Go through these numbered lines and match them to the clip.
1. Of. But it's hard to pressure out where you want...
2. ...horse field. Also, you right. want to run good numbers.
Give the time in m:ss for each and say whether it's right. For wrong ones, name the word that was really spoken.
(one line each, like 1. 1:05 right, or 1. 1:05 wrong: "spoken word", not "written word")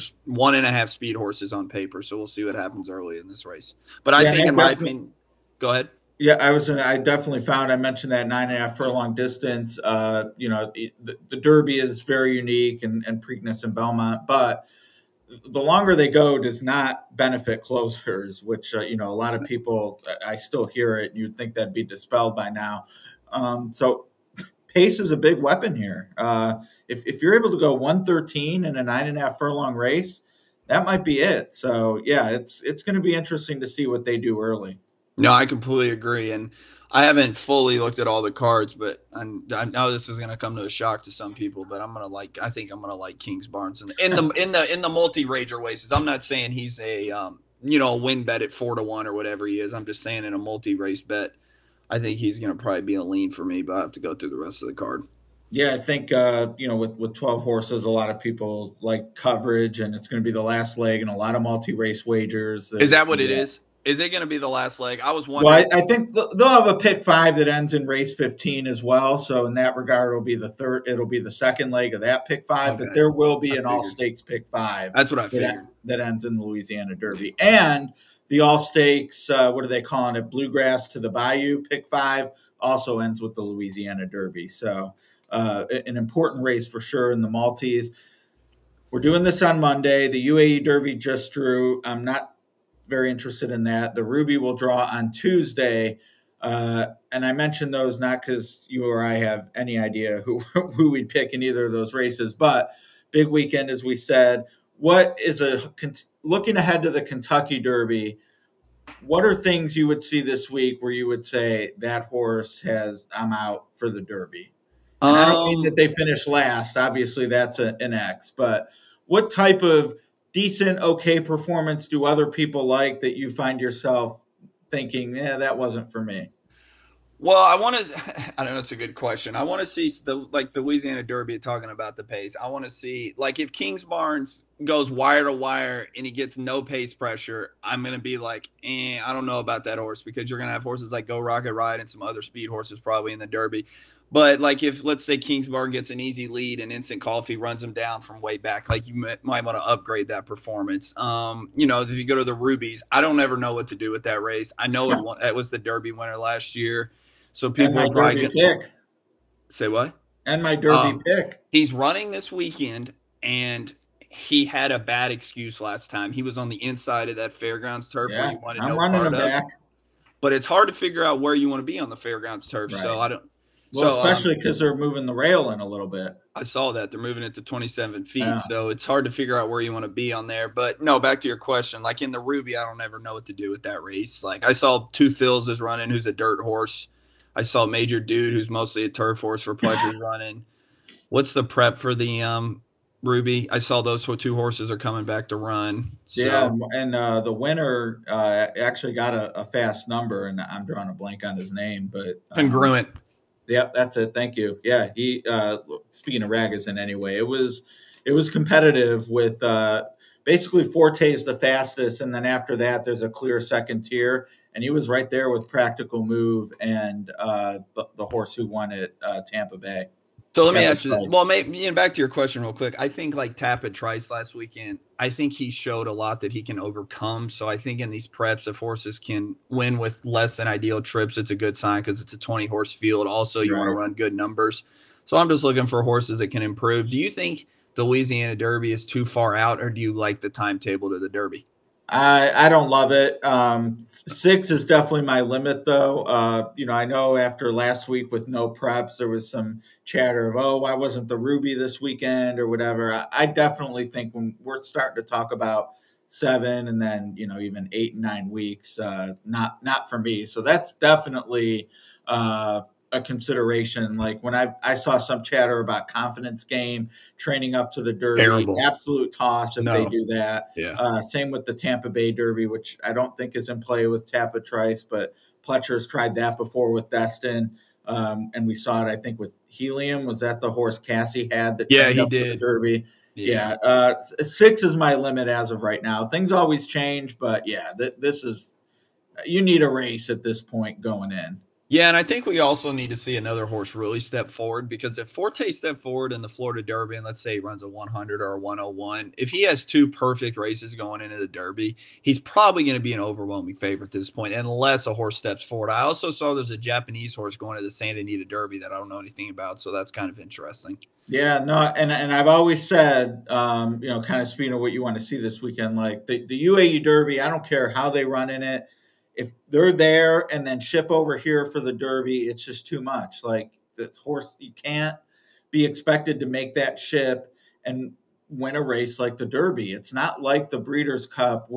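1. 2:49 wrong: "figure", not "pressure"
2. 3:52 right.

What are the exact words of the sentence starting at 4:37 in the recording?
Um, and we saw it, I think, with Helium.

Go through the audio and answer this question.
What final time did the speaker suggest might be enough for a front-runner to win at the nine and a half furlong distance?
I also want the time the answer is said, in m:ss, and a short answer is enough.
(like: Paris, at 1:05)
1:13, at 0:27.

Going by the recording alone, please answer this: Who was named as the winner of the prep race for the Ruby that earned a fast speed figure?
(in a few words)
Congruent.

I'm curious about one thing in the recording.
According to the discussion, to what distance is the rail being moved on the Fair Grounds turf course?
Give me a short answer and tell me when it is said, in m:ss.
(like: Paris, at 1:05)
27 feet, at 2:57.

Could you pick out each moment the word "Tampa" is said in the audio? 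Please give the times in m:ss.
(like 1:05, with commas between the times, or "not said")
3:39, 4:31.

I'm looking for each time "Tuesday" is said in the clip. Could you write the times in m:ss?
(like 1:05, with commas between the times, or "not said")
1:35.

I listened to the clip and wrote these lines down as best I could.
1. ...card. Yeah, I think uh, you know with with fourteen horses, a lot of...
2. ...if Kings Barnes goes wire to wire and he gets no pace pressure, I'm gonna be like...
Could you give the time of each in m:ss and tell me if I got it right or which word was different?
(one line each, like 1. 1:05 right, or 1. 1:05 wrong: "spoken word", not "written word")
1. 0:54 wrong: "twelve", not "fourteen"
2. 2:13 right.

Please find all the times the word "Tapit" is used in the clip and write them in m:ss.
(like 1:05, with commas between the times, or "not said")
3:43, 4:34.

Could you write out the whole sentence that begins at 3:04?
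Like I saw two Phils is running, who's a dirt horse.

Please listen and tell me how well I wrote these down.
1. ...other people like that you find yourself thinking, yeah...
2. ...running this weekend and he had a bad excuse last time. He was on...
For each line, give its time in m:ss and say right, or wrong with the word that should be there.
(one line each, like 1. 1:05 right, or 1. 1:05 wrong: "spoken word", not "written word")
1. 2:02 right
2. 2:41 right.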